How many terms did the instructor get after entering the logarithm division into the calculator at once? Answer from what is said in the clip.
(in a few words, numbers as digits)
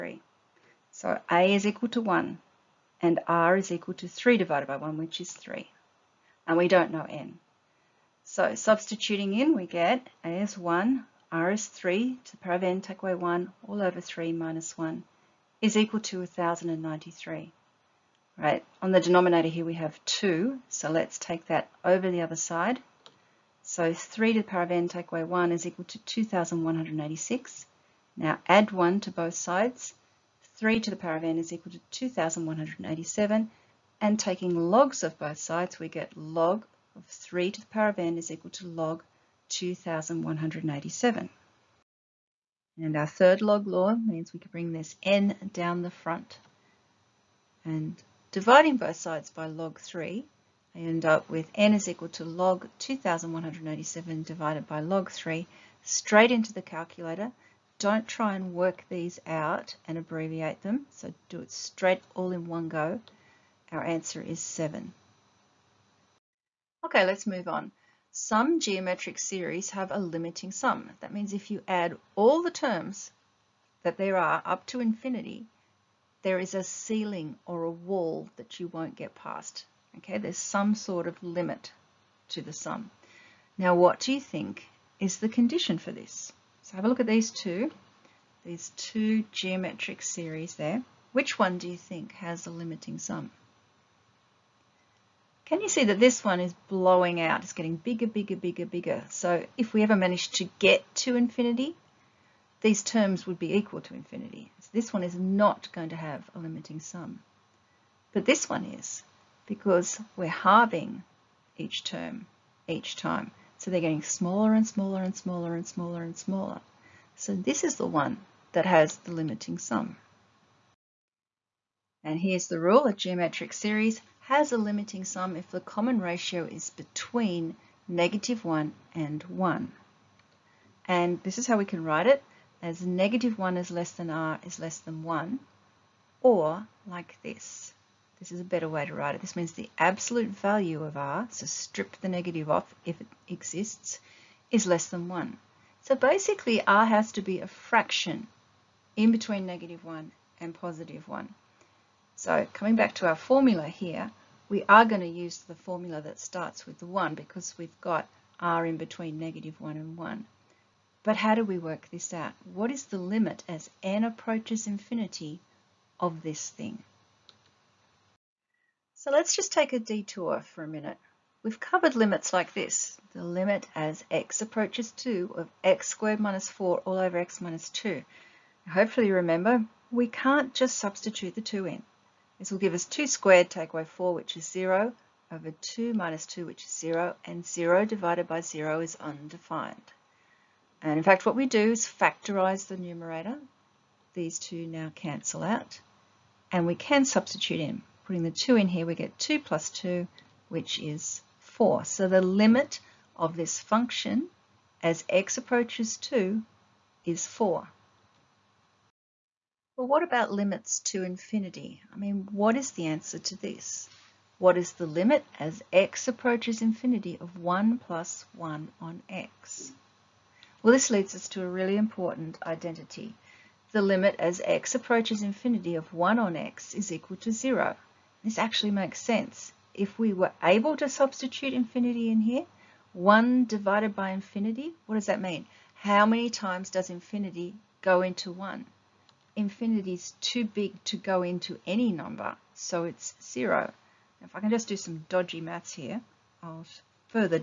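7.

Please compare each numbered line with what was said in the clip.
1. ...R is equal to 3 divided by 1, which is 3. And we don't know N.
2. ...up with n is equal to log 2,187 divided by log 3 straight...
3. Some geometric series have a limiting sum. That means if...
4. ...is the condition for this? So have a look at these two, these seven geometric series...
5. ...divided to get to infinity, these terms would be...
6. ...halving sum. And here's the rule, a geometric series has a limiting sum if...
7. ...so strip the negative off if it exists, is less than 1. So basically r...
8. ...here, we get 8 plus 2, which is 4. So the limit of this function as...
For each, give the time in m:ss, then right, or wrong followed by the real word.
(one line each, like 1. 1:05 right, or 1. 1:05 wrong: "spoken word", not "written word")
1. 0:03 right
2. 0:51 right
3. 1:08 right
4. 1:24 wrong: "two", not "seven"
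5. 1:39 wrong: "managed", not "divided"
6. 1:59 wrong: "limiting", not "halving"
7. 2:21 right
8. 3:18 wrong: "2", not "8".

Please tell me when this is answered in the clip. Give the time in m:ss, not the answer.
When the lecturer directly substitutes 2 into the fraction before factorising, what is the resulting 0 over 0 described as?
3:09.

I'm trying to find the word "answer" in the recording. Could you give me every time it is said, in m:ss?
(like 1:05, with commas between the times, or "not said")
1:03, 3:32.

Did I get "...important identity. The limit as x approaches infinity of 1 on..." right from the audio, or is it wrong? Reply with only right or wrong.
right.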